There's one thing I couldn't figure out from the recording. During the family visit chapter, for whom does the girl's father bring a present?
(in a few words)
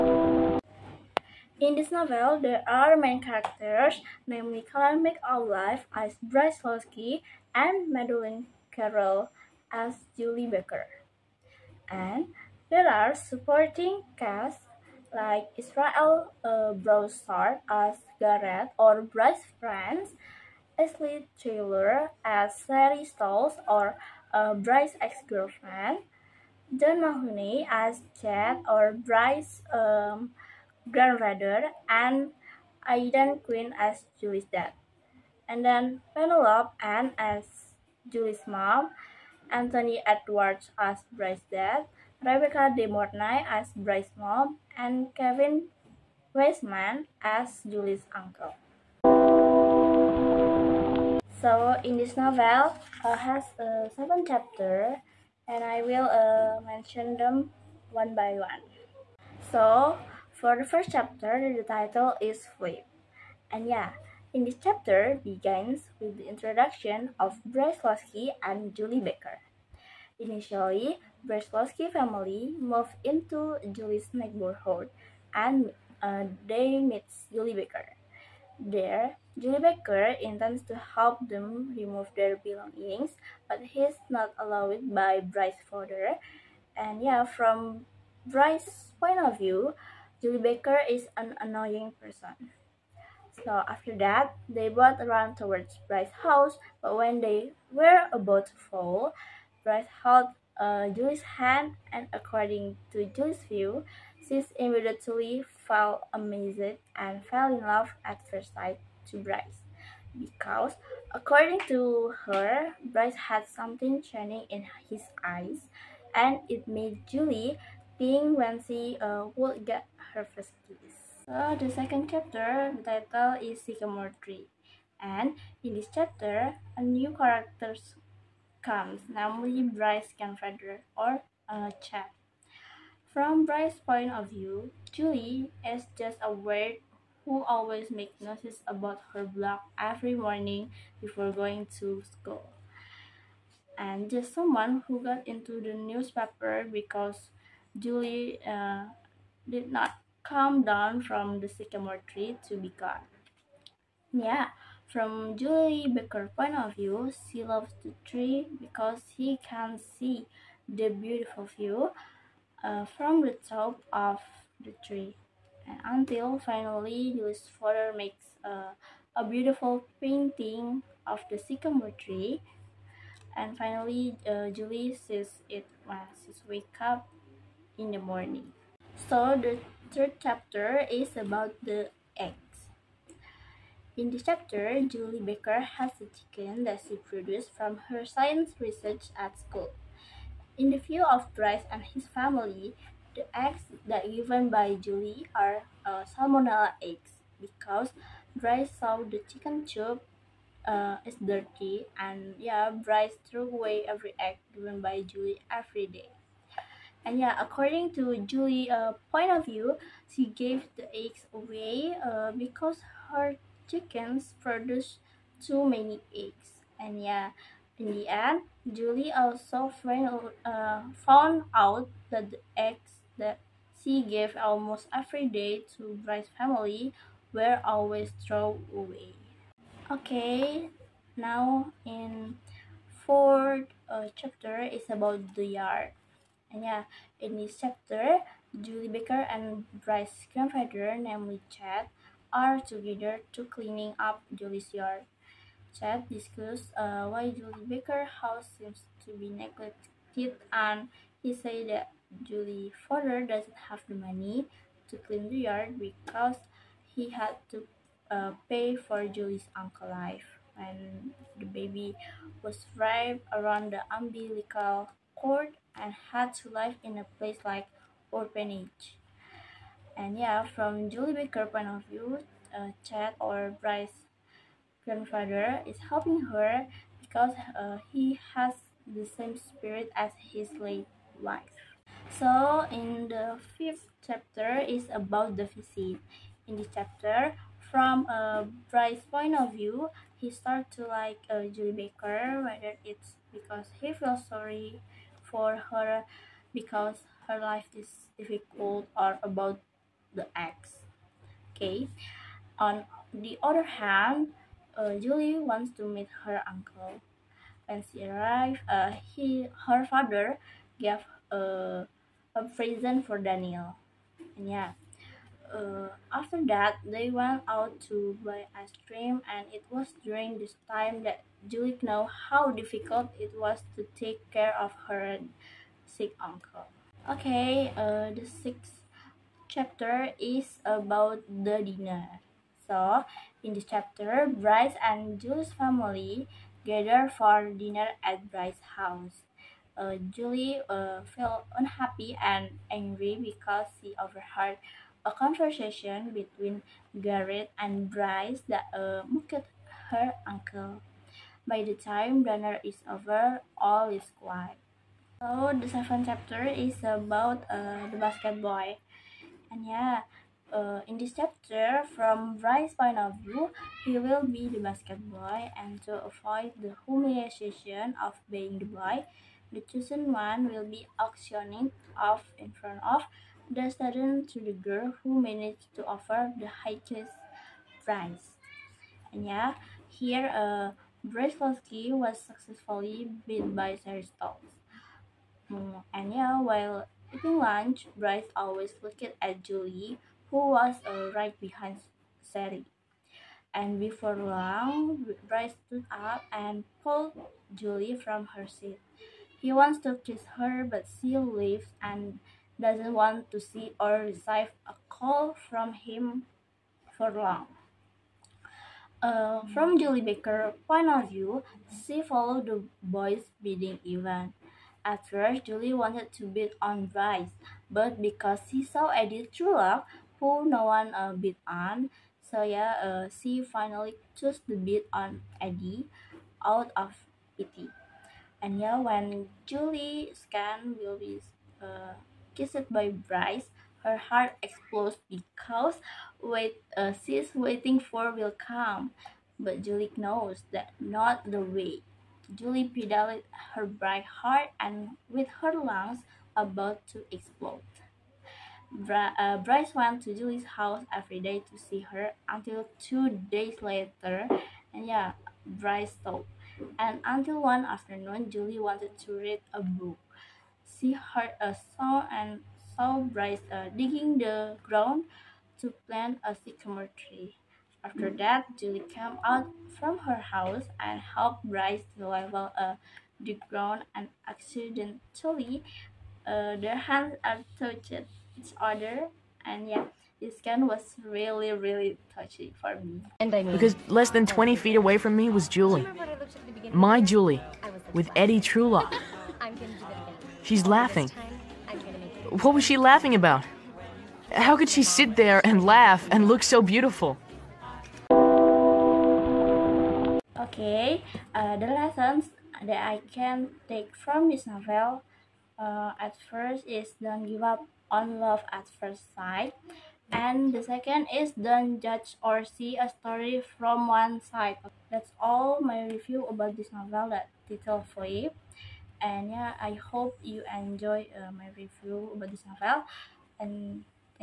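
Daniel.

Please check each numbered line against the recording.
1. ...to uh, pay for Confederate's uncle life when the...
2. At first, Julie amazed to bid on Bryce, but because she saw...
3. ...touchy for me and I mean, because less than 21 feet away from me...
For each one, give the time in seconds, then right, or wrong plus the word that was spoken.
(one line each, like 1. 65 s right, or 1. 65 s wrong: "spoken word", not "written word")
1. 257 s wrong: "Julie", not "Confederate"
2. 414 s wrong: "wanted", not "amazed"
3. 482 s wrong: "20", not "21".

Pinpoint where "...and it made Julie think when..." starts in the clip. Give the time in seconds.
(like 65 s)
116 s.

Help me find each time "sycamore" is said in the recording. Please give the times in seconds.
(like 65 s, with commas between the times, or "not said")
123 s, 151 s, 171 s, 466 s.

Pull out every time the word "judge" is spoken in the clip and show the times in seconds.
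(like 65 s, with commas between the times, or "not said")
511 s.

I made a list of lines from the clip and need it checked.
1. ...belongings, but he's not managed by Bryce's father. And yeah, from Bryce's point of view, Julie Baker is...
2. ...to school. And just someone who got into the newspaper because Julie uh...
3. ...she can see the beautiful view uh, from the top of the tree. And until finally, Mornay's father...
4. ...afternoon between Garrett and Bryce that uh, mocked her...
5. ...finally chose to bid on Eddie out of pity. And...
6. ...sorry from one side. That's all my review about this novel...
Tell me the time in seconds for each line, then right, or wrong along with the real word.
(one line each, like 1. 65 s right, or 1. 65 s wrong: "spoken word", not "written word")
1. 82 s wrong: "allowed", not "managed"
2. 141 s right
3. 159 s wrong: "Julie", not "Mornay"
4. 345 s wrong: "conversation", not "afternoon"
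5. 423 s right
6. 512 s wrong: "story", not "sorry".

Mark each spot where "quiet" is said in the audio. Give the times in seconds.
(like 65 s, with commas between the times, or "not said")
354 s.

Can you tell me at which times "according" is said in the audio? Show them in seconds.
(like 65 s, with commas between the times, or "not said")
102 s, 111 s, 207 s.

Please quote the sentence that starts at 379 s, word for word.
And yeah, here uh, Brzezinski was successfully beat by Seristov.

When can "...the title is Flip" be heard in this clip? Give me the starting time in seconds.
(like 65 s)
61 s.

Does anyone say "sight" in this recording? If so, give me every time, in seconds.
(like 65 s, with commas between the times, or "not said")
108 s, 509 s.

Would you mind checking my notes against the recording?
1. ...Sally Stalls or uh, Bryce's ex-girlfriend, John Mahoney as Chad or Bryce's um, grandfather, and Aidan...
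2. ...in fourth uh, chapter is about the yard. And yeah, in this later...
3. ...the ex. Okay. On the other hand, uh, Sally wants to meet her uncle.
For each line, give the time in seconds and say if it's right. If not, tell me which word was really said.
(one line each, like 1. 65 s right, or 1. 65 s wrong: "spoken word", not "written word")
1. 22 s right
2. 231 s wrong: "chapter", not "later"
3. 300 s wrong: "Julie", not "Sally".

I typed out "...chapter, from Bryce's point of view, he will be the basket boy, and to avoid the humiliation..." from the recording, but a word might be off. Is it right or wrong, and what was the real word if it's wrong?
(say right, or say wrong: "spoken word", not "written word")
right.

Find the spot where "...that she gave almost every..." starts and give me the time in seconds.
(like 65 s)
223 s.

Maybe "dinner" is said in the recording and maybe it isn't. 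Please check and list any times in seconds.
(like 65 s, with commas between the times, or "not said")
331 s, 337 s, 352 s.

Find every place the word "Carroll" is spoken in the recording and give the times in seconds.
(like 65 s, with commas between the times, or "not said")
8 s.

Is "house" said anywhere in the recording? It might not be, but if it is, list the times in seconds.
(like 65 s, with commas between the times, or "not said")
96 s, 248 s, 338 s, 450 s, 470 s.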